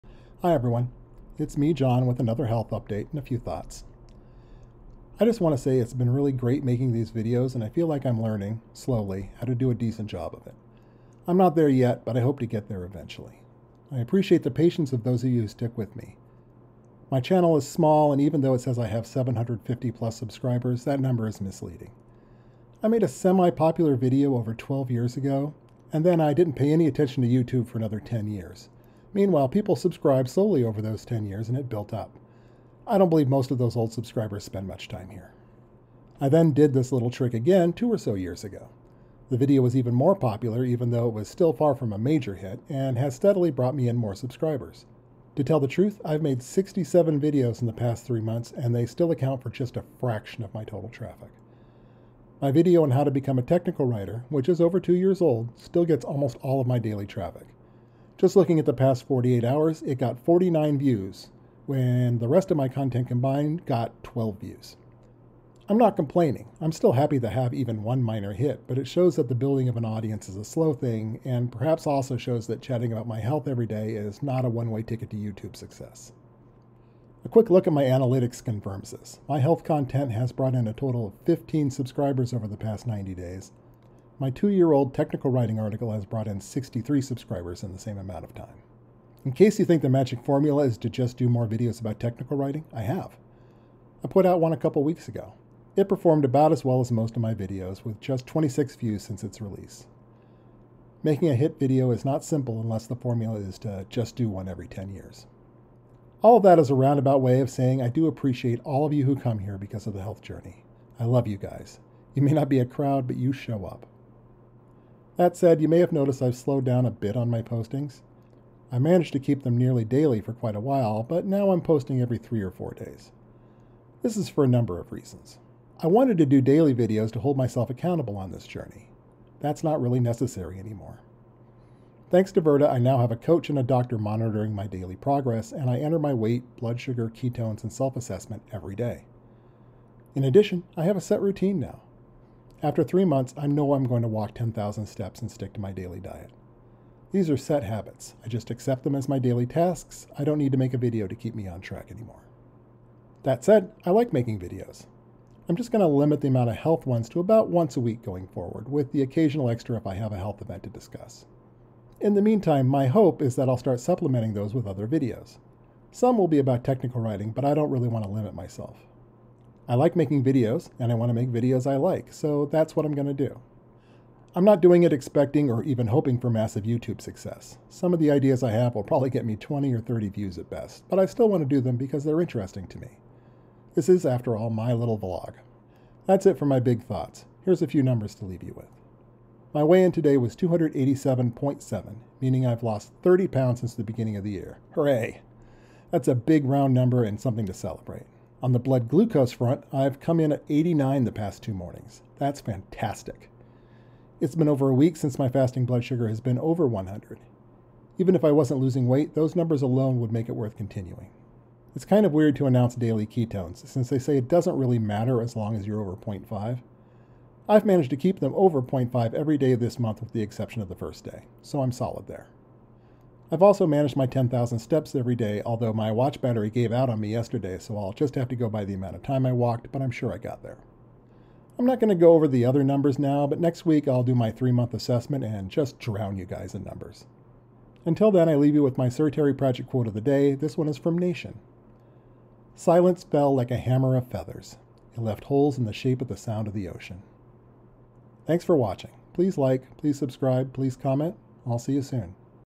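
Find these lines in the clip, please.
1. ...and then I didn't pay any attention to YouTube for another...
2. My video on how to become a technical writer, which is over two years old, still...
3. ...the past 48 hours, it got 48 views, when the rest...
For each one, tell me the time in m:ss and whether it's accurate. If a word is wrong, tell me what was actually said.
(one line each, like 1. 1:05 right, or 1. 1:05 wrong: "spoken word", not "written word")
1. 0:25 right
2. 0:52 right
3. 0:58 wrong: "49", not "48".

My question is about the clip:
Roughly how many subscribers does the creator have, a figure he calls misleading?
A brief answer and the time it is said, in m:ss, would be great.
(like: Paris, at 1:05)
750, at 0:19.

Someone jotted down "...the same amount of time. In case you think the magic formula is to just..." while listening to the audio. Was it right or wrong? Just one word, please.
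right.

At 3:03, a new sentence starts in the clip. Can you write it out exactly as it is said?
This is, after all, my little vlog.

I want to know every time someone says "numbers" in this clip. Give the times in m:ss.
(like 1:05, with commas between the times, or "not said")
0:20, 2:04, 3:07, 3:16, 3:29, 3:52, 3:56.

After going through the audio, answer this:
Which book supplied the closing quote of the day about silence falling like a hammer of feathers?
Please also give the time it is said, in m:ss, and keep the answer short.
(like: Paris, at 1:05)
Nation, at 4:00.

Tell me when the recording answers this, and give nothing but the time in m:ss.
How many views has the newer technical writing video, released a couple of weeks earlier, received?
1:38.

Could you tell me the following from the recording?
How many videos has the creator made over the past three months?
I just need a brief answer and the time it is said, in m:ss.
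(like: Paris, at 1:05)
67, at 0:46.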